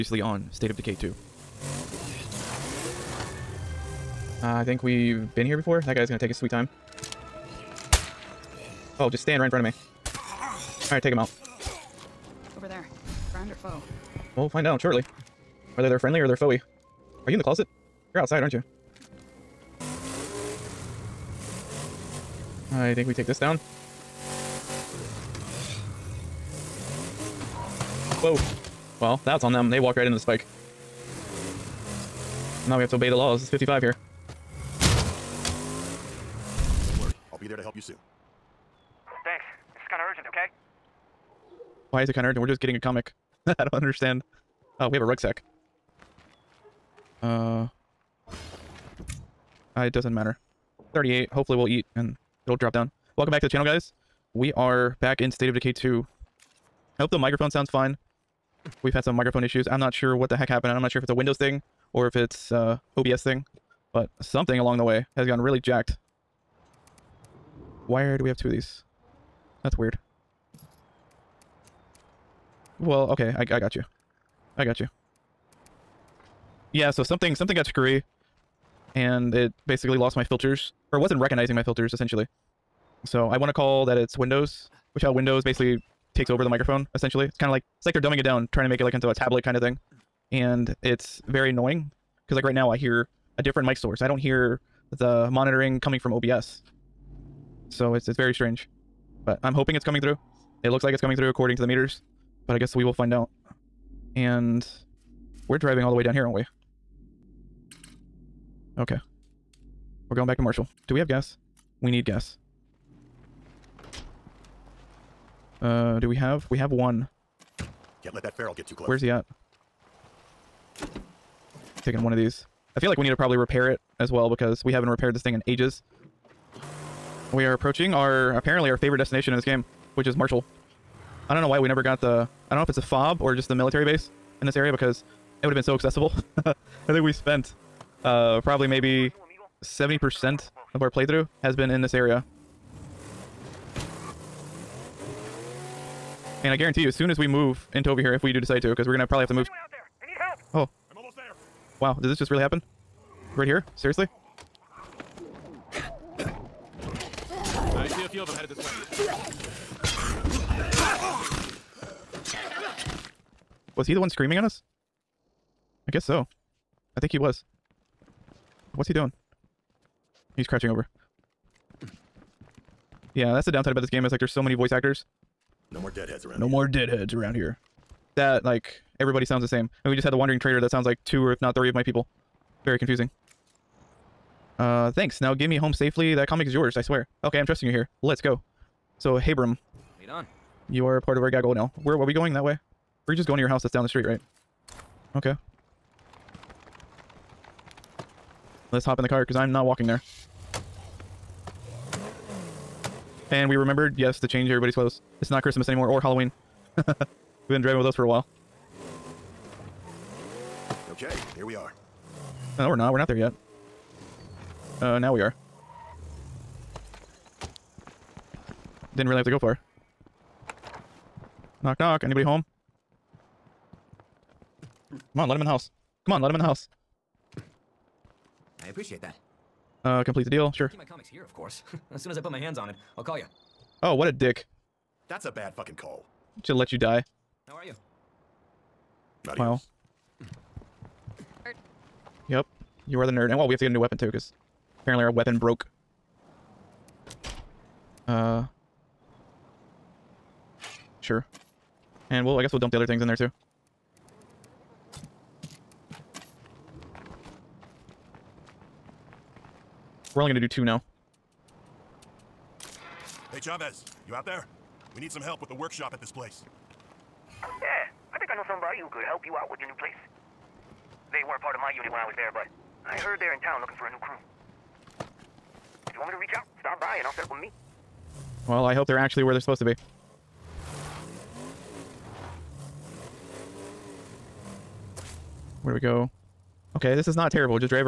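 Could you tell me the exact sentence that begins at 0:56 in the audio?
I hope the microphone sounds fine.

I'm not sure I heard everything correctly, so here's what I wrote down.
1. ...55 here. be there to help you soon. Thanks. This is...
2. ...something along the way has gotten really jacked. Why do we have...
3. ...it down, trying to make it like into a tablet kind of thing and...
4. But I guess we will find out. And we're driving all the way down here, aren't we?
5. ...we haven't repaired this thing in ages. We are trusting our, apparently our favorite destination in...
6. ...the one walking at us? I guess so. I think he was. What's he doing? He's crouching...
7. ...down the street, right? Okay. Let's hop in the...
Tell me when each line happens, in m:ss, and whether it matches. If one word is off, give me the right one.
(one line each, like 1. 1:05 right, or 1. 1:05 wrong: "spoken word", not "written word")
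1. 0:33 right
2. 1:04 right
3. 1:28 right
4. 1:42 right
5. 2:04 wrong: "approaching", not "trusting"
6. 2:43 wrong: "screaming", not "walking"
7. 3:13 right.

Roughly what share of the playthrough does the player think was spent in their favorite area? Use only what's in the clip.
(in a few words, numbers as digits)
70%.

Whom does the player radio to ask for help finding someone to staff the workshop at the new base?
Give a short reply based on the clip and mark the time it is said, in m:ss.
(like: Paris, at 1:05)
Chavez, at 4:23.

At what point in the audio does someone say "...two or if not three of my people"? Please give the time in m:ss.
3:01.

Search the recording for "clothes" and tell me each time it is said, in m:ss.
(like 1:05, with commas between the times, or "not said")
3:24.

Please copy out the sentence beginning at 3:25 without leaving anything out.
It's not Christmas anymore or Halloween.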